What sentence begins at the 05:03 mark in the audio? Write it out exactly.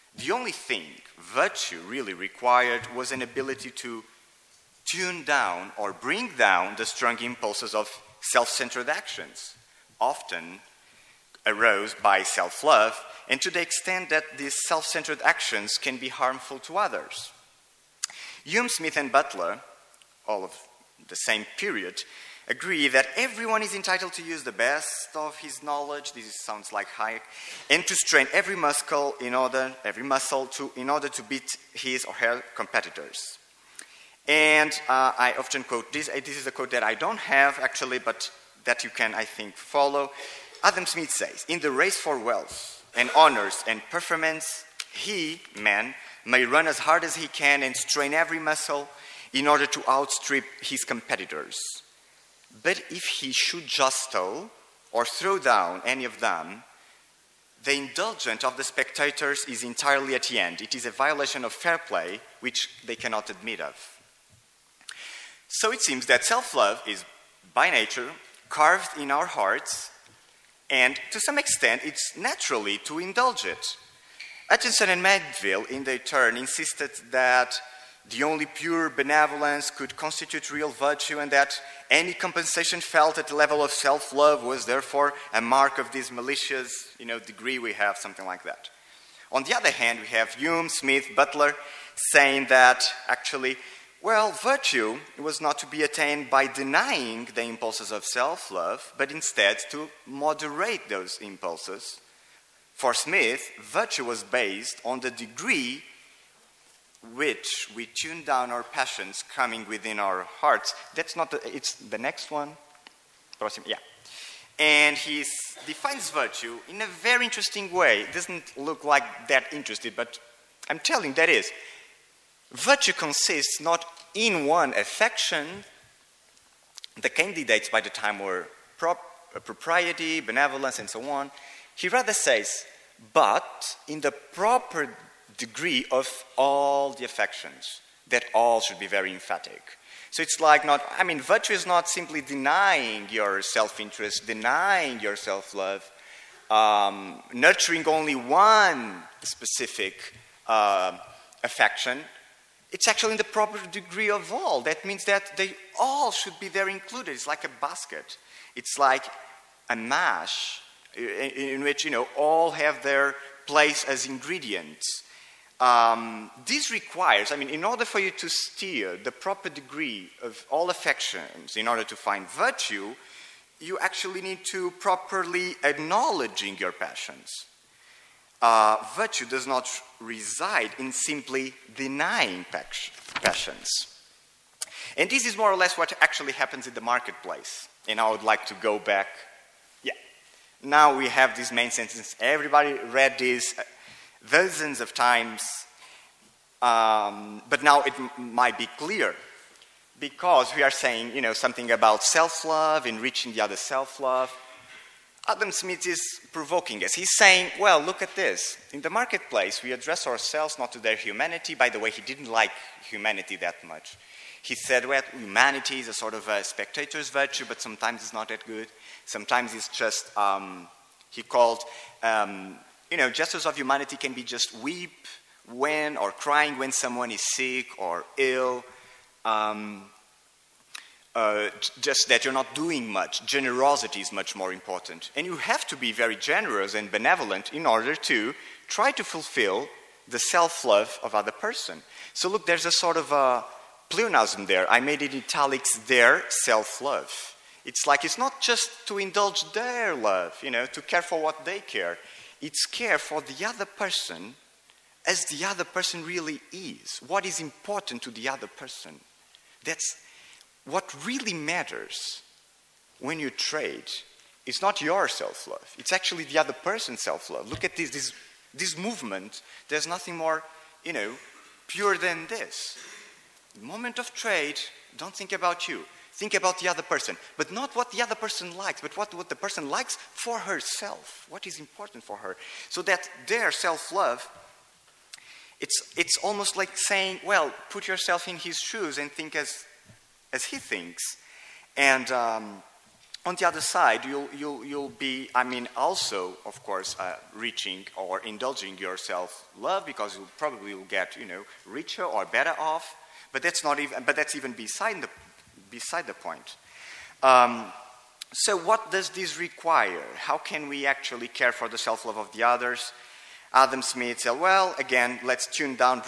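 But that's not even, but that's even beside the, beside the point.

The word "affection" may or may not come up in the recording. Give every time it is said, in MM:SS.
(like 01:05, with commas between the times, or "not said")
02:04, 02:17, 02:31, 02:50.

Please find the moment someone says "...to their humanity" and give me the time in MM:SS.
03:30.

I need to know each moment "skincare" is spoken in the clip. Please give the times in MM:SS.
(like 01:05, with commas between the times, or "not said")
not said.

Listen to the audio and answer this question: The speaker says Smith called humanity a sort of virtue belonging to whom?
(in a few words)
spectator.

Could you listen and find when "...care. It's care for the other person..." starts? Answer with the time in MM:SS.
04:11.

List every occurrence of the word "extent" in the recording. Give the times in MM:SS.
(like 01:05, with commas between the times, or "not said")
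00:13, 01:11.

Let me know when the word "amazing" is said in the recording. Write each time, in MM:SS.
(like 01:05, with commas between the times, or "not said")
not said.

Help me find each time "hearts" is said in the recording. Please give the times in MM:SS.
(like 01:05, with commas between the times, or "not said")
01:09, 01:50.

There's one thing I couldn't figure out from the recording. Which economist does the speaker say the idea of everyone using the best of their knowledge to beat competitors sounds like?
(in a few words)
Hayek.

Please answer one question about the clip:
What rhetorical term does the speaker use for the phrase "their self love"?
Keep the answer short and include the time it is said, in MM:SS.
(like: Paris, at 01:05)
pleonasm, at 04:03.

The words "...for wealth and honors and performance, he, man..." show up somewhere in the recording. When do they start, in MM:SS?
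00:41.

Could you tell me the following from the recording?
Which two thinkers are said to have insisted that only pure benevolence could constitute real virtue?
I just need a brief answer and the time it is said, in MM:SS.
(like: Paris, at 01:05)
Hutcheson and Mandeville, at 01:14.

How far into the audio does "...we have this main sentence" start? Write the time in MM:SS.
03:10.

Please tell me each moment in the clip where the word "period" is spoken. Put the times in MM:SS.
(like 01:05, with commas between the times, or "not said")
00:21.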